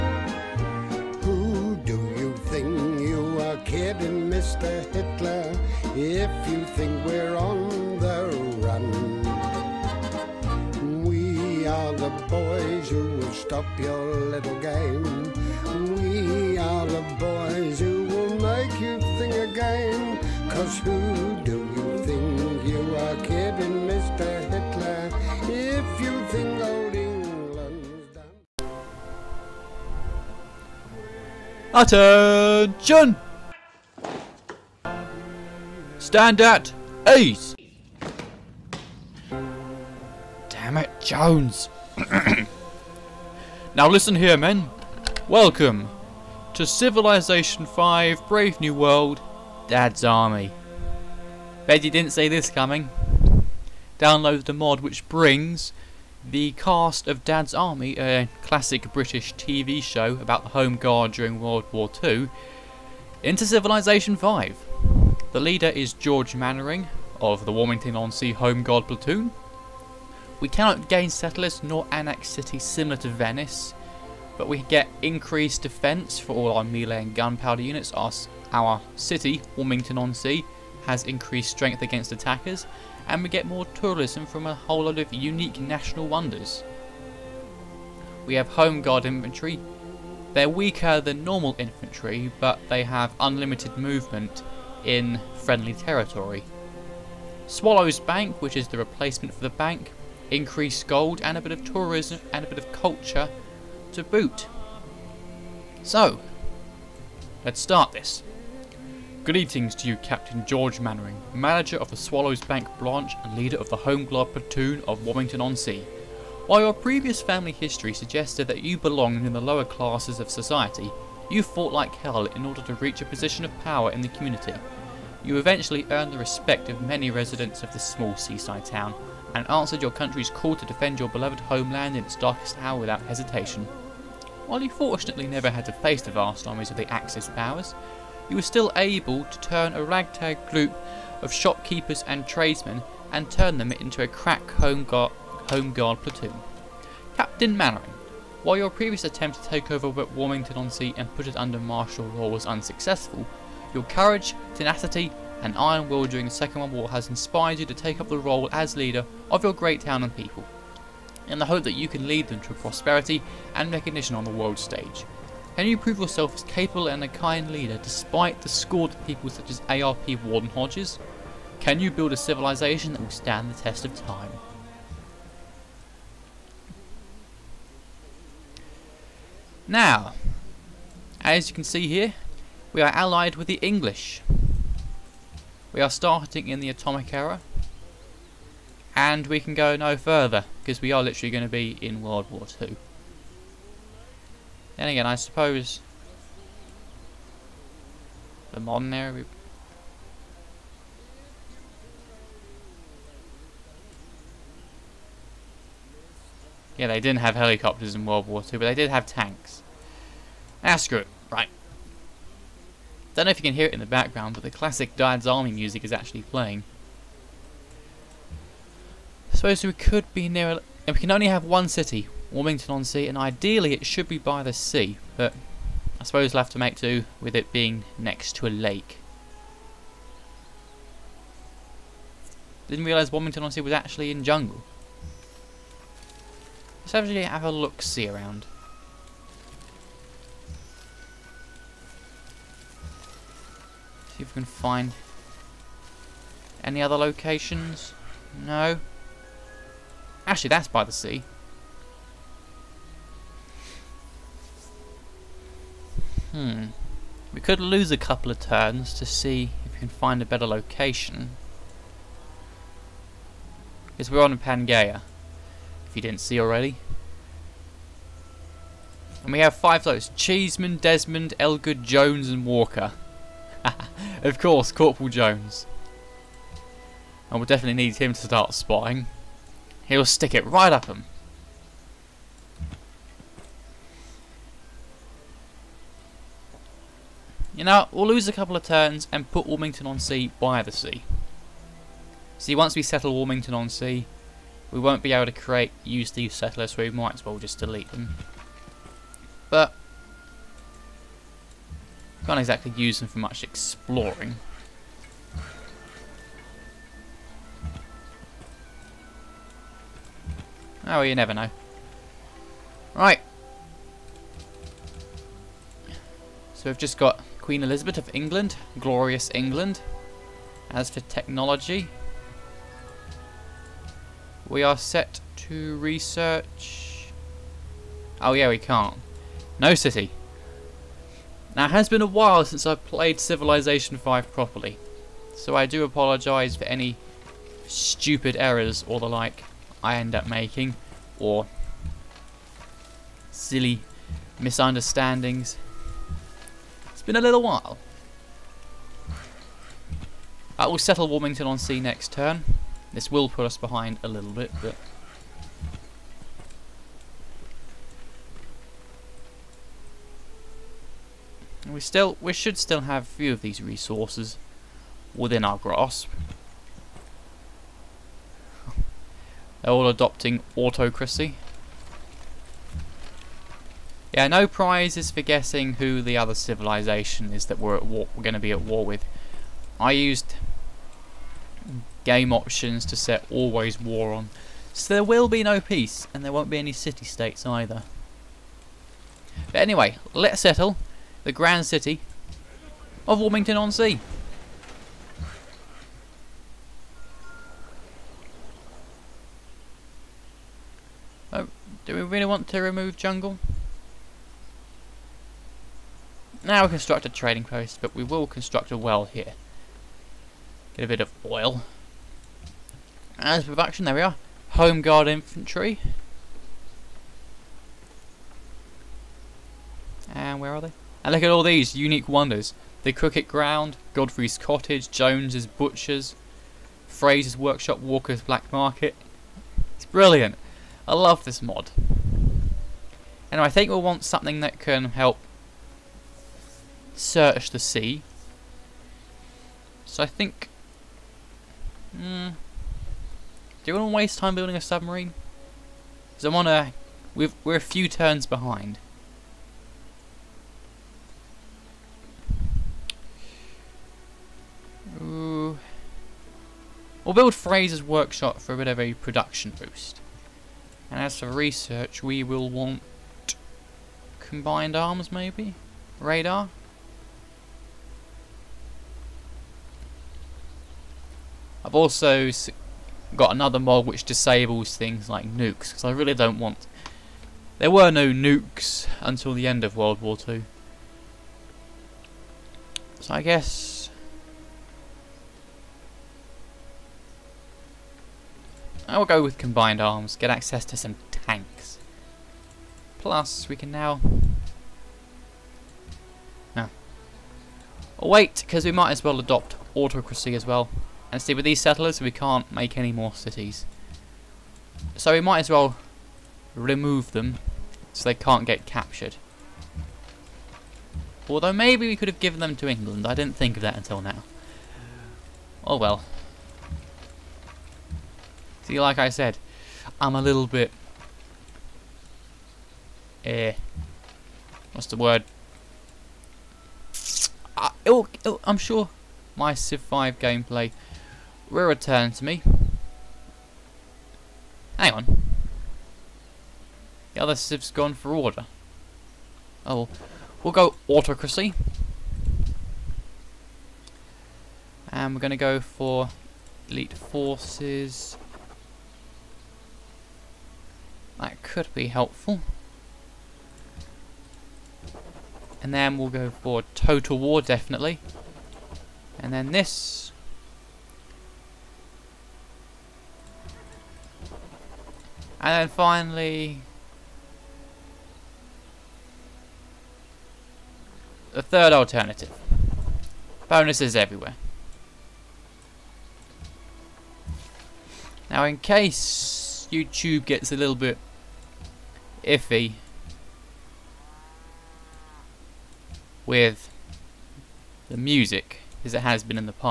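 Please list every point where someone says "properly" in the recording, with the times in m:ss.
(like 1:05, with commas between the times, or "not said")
5:34.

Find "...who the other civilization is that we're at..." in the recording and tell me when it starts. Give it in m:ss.
6:15.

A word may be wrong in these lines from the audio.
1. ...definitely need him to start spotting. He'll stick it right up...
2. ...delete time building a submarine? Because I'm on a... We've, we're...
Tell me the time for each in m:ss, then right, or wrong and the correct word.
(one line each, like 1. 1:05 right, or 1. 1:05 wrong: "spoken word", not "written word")
1. 4:37 right
2. 7:23 wrong: "waste", not "delete".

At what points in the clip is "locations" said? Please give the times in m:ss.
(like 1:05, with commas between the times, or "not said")
4:06, 4:20.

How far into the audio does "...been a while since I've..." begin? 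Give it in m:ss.
5:31.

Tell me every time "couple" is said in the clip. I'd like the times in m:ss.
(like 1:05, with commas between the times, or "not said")
4:17, 4:48.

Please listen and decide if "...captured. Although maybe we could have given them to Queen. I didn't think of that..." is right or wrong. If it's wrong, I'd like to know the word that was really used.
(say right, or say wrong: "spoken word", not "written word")
wrong: "England", not "Queen".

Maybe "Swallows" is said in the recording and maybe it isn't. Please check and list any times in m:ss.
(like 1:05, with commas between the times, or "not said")
1:37, 1:51.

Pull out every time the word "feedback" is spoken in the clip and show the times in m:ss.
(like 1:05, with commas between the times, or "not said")
not said.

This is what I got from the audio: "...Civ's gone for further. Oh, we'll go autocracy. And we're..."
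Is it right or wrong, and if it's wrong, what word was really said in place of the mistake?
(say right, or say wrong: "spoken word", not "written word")
wrong: "order", not "further".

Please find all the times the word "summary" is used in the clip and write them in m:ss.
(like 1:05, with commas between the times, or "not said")
not said.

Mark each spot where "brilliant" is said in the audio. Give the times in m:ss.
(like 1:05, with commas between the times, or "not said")
7:09.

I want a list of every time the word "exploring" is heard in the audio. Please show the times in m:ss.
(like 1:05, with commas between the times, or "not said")
5:03.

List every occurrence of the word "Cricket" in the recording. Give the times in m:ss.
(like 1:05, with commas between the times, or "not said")
7:02.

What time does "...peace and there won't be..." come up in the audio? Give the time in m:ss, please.
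6:25.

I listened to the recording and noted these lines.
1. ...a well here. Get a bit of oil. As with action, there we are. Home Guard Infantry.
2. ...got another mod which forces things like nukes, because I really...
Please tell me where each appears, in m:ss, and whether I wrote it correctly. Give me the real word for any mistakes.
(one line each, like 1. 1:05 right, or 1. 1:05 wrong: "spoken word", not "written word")
1. 6:48 right
2. 7:53 wrong: "disables", not "forces".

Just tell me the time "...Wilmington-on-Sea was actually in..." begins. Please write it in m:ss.
3:53.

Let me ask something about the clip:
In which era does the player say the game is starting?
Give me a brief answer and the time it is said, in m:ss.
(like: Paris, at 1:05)
Atomic era, at 3:06.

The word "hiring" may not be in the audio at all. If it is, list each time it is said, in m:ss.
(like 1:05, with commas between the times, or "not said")
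not said.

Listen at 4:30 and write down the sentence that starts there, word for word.
Cheeseman, Desmond, Elgood, Jones and Walker.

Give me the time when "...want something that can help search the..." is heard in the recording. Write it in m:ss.
7:13.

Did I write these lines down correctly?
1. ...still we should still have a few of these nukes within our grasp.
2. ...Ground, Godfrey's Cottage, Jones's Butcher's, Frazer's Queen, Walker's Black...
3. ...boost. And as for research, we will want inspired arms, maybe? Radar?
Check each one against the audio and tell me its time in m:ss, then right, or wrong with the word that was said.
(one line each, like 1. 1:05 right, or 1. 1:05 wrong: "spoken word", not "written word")
1. 6:01 wrong: "resources", not "nukes"
2. 7:03 wrong: "Workshop", not "Queen"
3. 7:39 wrong: "combined", not "inspired".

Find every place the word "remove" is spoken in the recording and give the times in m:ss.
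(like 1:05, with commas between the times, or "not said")
6:42, 8:26.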